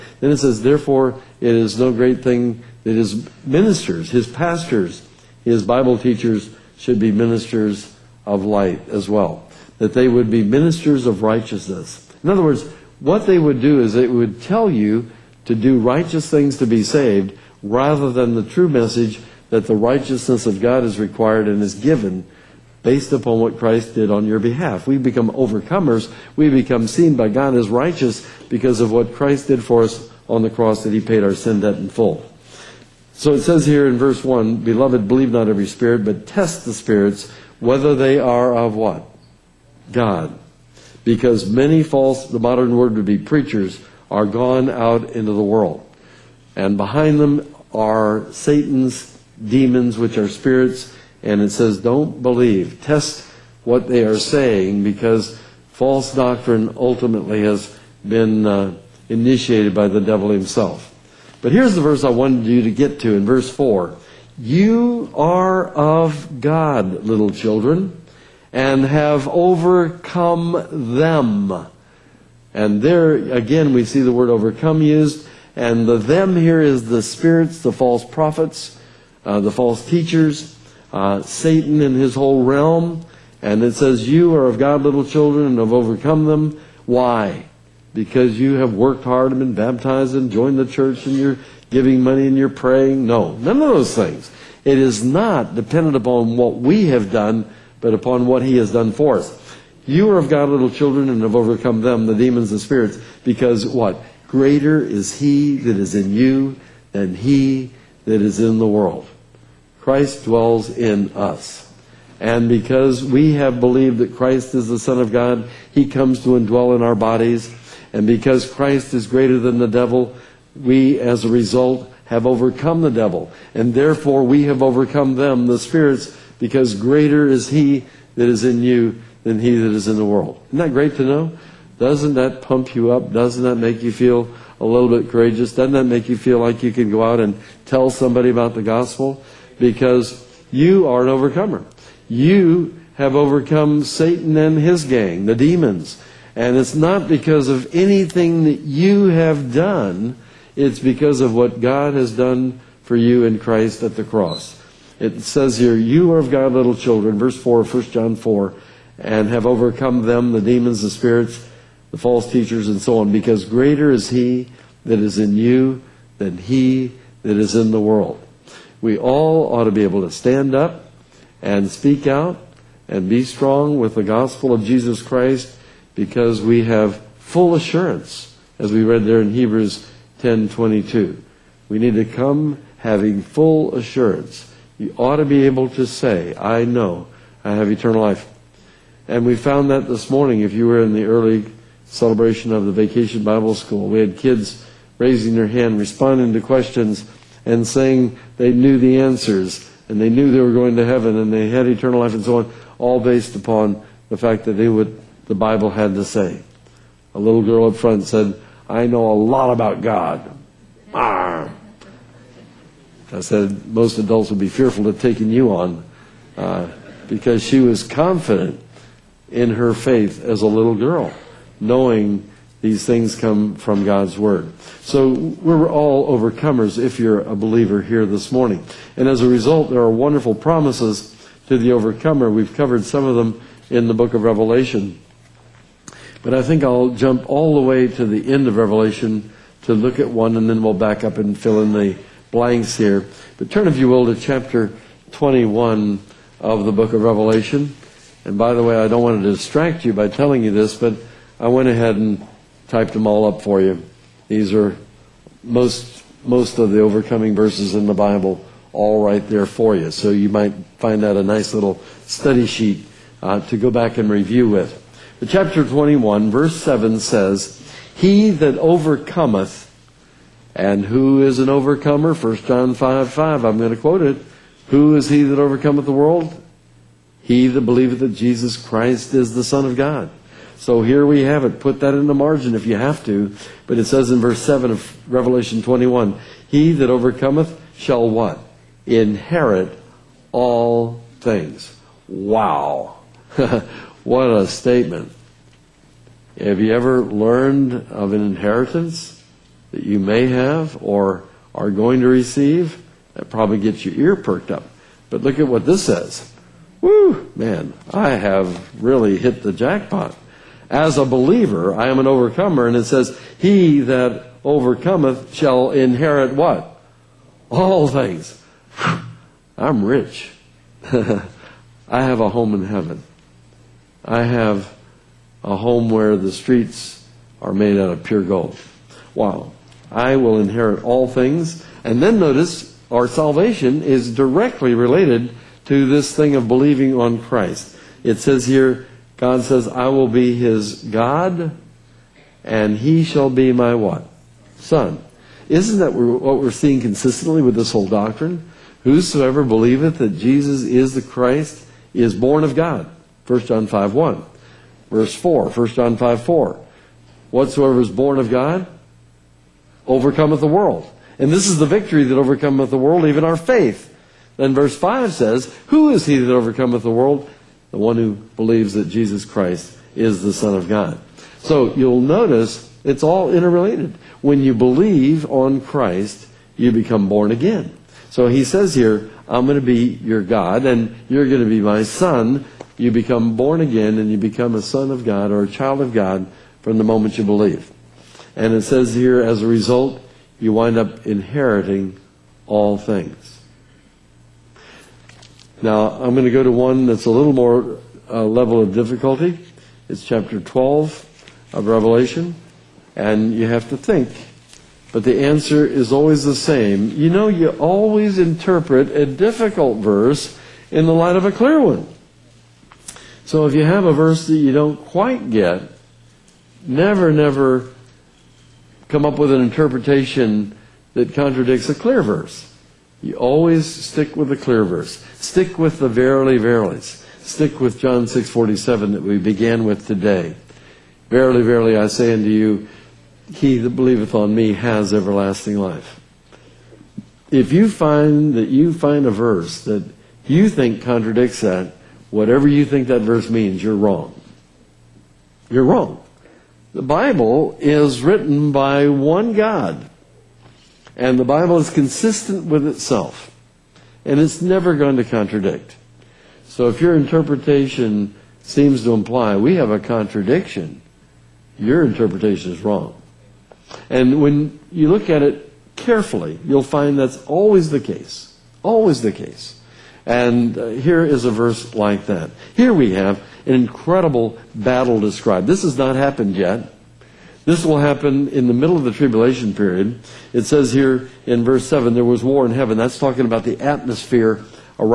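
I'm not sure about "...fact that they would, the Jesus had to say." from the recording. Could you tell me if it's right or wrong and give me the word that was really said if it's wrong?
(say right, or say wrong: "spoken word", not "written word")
wrong: "Bible", not "Jesus".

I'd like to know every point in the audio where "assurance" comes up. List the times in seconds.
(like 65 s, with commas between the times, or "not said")
177 s, 183 s.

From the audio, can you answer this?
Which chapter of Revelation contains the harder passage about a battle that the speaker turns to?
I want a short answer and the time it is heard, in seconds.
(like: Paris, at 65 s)
Chapter 12, at 400 s.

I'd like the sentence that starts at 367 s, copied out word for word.
the one who believes that Jesus Christ is the Son of God.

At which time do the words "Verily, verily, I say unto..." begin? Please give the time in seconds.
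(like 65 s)
431 s.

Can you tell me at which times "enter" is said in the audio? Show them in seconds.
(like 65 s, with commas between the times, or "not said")
not said.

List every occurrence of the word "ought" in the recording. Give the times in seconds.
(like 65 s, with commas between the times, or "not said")
169 s, 184 s.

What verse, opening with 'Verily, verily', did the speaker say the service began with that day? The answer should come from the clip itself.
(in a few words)
John 6:47.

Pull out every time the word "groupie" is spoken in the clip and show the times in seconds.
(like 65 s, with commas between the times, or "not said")
not said.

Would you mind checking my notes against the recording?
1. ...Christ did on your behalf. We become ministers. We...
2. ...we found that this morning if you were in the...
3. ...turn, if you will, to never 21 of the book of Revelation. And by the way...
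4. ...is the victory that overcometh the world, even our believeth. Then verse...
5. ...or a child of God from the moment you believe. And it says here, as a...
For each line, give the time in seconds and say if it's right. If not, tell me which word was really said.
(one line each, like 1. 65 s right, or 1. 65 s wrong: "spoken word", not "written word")
1. 23 s wrong: "overcomers", not "ministers"
2. 189 s right
3. 243 s wrong: "chapter", not "never"
4. 361 s wrong: "faith", not "believeth"
5. 385 s right.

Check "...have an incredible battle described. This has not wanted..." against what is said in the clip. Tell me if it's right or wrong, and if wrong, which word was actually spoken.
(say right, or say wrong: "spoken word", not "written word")
wrong: "happened", not "wanted".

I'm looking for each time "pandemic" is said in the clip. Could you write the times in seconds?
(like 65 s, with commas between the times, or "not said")
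not said.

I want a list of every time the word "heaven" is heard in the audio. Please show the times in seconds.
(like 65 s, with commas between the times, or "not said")
200 s, 322 s, 482 s.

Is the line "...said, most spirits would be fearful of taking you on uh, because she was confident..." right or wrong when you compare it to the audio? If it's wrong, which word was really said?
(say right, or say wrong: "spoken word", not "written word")
wrong: "adults", not "spirits".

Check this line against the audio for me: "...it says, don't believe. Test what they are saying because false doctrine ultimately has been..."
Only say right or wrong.
right.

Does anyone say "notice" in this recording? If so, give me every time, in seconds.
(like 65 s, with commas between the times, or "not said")
332 s, 372 s.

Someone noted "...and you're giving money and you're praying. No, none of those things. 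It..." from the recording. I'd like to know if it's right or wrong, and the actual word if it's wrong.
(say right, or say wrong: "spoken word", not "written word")
right.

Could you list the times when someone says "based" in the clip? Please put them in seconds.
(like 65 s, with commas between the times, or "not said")
22 s, 203 s.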